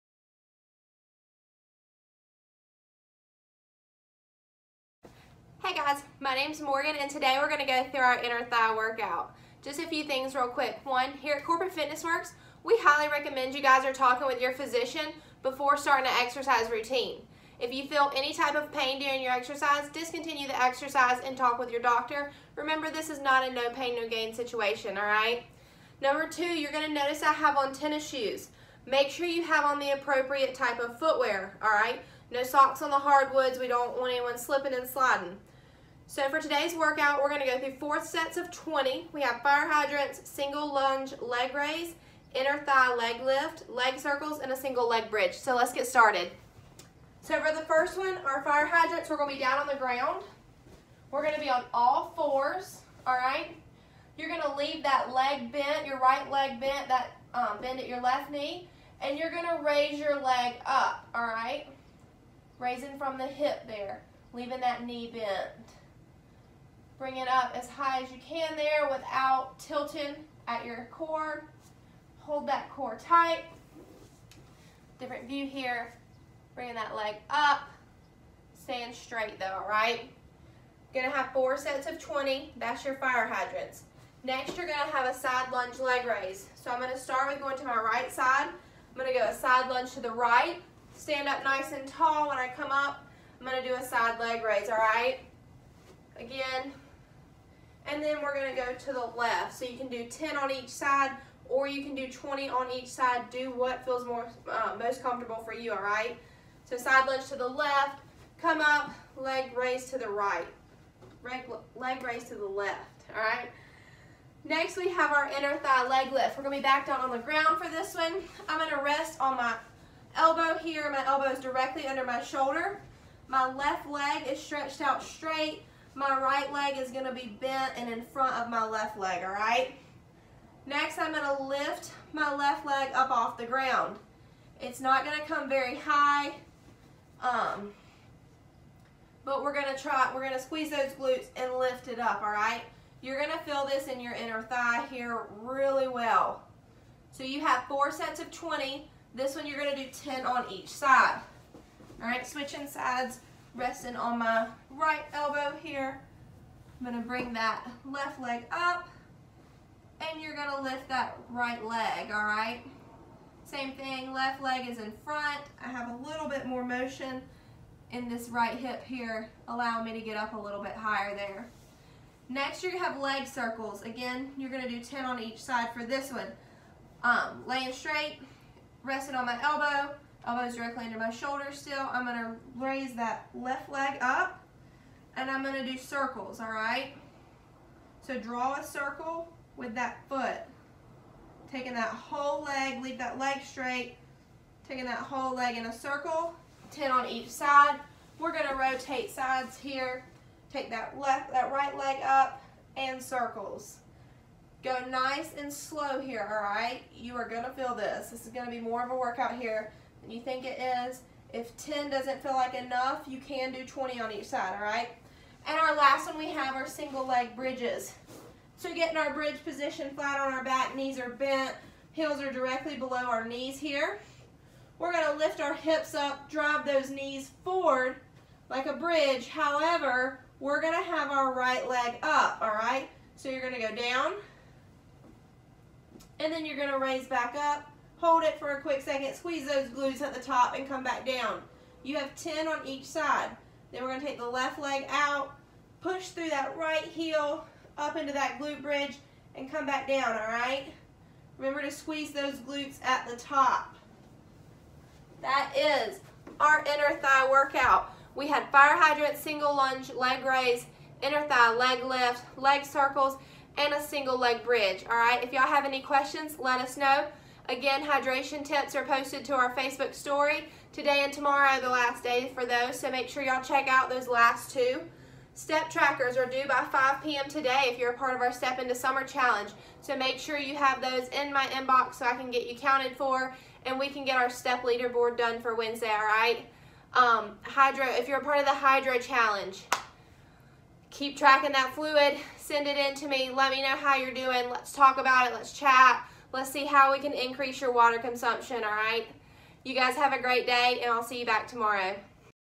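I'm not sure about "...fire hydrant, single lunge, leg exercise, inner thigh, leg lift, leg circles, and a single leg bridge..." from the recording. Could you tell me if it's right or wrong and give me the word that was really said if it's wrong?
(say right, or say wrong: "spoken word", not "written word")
wrong: "raise", not "exercise".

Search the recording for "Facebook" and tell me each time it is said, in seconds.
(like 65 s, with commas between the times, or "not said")
269 s.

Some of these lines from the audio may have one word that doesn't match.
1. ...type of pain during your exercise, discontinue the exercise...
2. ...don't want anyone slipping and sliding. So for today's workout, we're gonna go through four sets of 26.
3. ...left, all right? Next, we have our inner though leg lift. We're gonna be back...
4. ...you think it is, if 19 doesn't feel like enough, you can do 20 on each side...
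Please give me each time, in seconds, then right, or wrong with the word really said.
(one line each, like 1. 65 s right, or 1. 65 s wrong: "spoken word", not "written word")
1. 18 s right
2. 33 s wrong: "20", not "26"
3. 112 s wrong: "thigh", not "though"
4. 210 s wrong: "10", not "19".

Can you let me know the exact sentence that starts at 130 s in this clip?
Next, I'm gonna lift my left leg up off the ground.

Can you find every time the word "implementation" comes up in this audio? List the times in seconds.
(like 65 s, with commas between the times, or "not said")
not said.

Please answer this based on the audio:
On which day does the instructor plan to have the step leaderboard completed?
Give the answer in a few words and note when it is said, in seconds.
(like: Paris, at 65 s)
Wednesday, at 285 s.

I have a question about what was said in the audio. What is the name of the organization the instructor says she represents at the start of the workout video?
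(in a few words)
Corporate Fitness Works.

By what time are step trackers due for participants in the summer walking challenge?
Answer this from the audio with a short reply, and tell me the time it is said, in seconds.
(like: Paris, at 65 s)
5 p.m., at 276 s.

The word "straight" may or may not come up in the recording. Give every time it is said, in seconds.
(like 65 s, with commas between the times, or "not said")
78 s, 125 s, 177 s, 193 s.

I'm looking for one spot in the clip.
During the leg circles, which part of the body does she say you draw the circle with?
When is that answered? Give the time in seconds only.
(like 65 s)
190 s.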